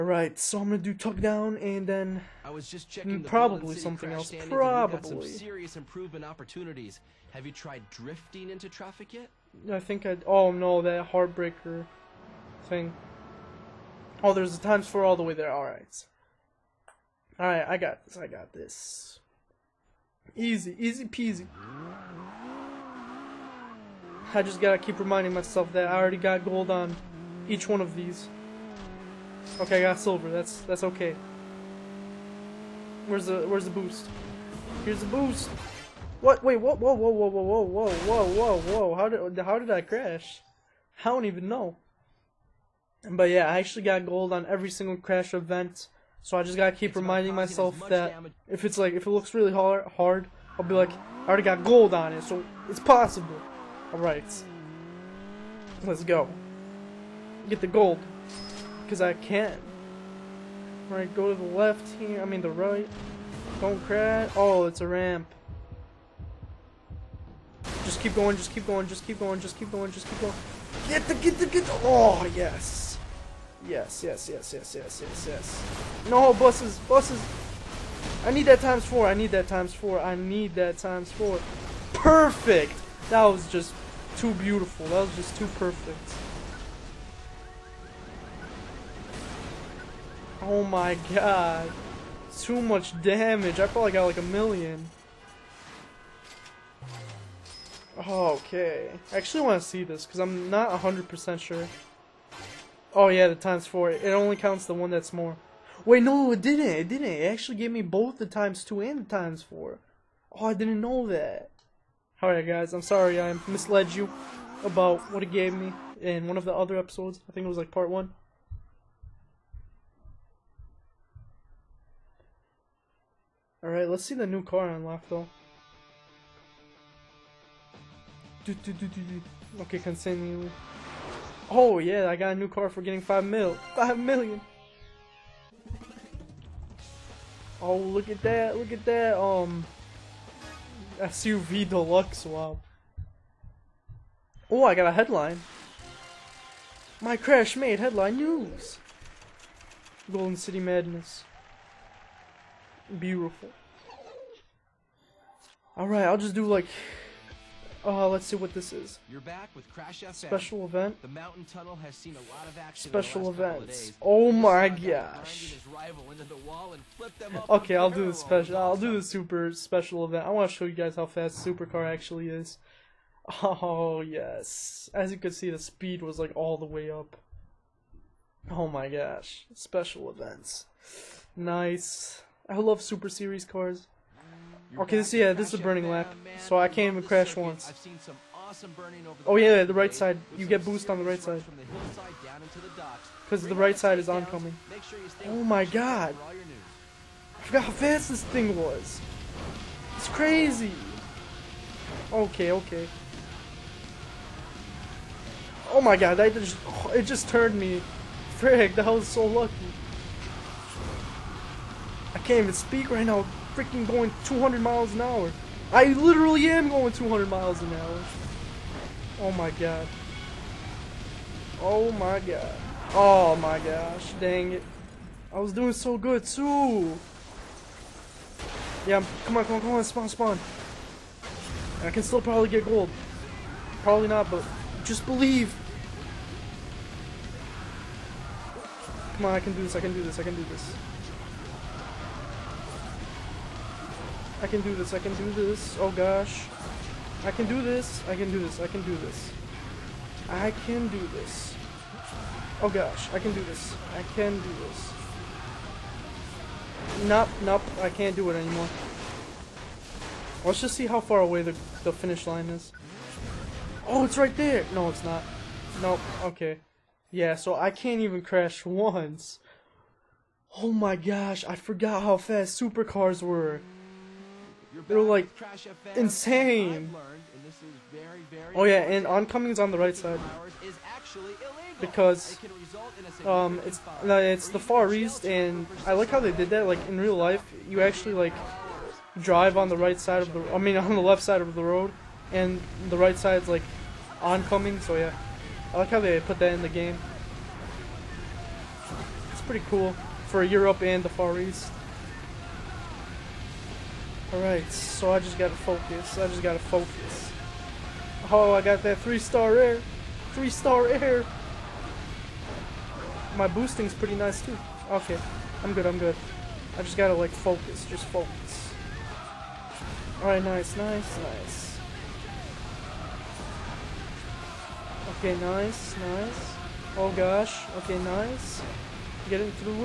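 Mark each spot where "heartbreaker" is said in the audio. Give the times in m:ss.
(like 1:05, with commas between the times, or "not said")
0:11.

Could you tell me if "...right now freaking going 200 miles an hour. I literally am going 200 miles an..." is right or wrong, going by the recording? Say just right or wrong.
right.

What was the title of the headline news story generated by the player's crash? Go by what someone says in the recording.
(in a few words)
Golden City Madness.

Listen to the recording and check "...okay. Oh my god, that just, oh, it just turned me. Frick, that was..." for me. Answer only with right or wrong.
right.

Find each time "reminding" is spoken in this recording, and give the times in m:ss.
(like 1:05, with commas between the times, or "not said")
0:24, 0:46.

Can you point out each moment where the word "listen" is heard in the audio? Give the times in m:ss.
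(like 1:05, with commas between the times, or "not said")
not said.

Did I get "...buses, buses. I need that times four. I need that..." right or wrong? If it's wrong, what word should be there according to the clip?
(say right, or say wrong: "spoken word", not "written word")
right.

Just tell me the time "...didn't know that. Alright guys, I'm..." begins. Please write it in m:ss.
1:50.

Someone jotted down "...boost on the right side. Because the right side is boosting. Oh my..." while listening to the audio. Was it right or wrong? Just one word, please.
wrong.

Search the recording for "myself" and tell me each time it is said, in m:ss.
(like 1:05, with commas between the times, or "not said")
0:25, 0:47.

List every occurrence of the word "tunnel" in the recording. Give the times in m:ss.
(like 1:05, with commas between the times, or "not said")
2:41.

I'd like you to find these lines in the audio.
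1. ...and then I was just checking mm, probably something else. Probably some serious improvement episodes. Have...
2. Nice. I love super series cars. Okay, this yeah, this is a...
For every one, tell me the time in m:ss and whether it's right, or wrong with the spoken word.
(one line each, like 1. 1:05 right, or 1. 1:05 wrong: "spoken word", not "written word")
1. 0:01 wrong: "opportunities", not "episodes"
2. 3:01 right.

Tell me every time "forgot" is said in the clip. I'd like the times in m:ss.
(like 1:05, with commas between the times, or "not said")
3:17, 4:31.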